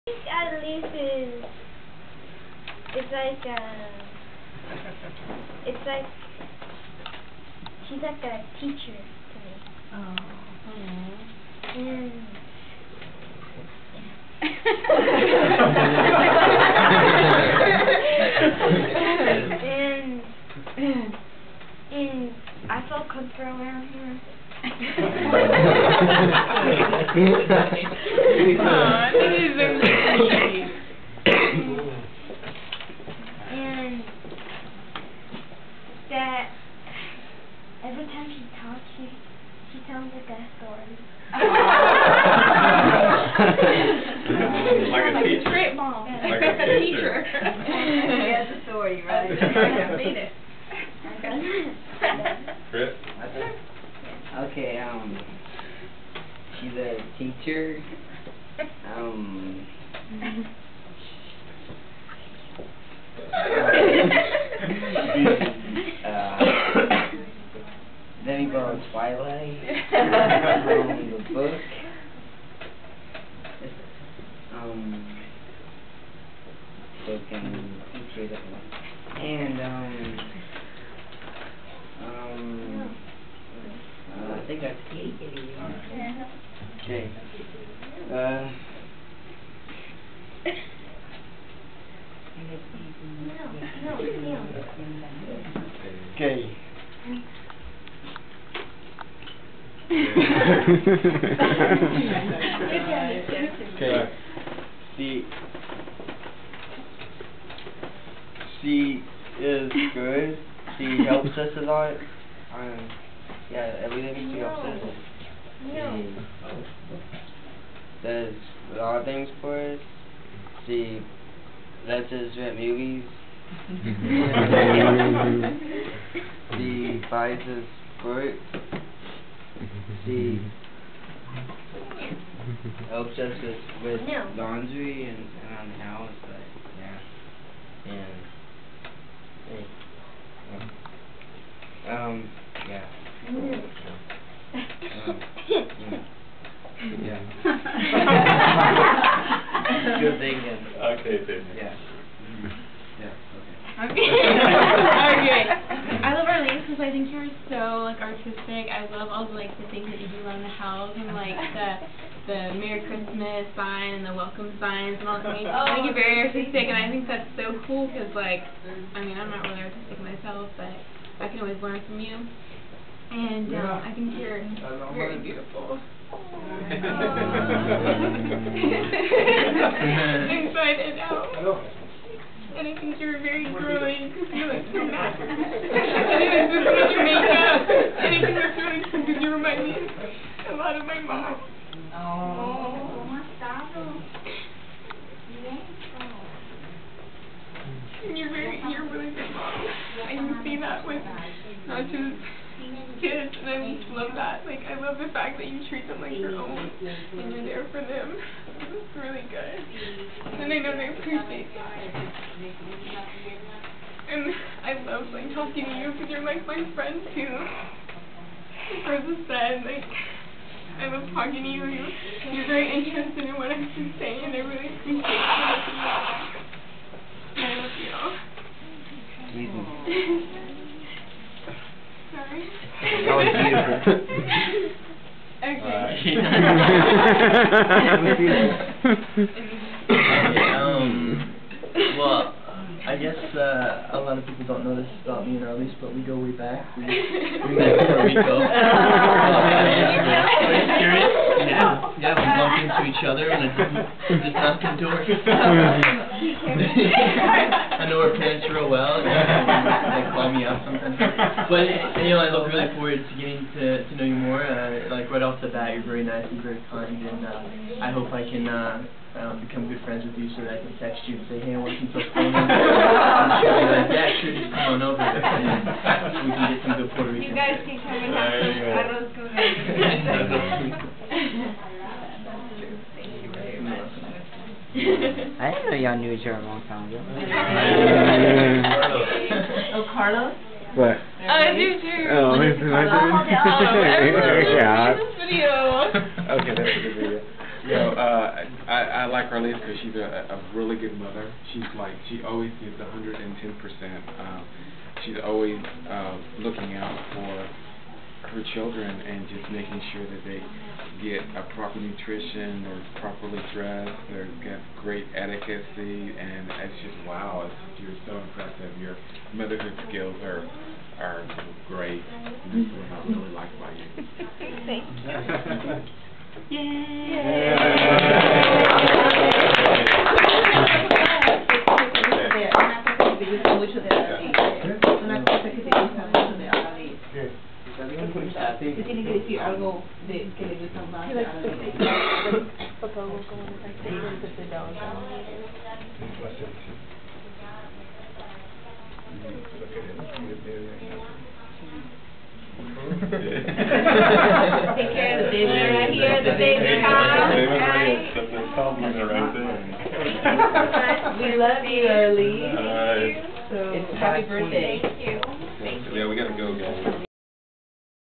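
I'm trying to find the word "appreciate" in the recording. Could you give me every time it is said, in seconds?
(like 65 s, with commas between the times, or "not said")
210 s, 224 s.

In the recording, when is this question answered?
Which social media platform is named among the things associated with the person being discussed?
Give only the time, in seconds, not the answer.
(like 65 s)
77 s.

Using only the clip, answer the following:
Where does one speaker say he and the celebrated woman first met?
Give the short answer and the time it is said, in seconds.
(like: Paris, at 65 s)
Puerto Rico, at 247 s.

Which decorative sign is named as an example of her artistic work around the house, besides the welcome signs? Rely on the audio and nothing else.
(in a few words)
Merry Christmas sign.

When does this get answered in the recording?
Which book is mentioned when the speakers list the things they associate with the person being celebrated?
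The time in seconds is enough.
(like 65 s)
68 s.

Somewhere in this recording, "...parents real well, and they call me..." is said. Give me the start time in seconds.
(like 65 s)
258 s.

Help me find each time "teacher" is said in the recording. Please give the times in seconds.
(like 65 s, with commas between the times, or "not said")
8 s, 46 s, 57 s.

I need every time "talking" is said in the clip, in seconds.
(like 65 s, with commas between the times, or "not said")
215 s, 221 s.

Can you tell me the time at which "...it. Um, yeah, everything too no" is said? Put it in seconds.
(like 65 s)
111 s.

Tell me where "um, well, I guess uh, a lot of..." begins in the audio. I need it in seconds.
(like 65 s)
240 s.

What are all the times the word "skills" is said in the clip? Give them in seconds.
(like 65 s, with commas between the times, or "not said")
319 s.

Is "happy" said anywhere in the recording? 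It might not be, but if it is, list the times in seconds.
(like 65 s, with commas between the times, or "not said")
363 s.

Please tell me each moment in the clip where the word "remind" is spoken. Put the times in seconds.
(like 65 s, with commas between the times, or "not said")
189 s.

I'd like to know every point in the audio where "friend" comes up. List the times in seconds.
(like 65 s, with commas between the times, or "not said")
216 s, 269 s.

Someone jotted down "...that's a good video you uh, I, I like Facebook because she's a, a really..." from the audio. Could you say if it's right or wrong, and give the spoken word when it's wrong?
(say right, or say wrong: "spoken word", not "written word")
wrong: "Arlene", not "Facebook".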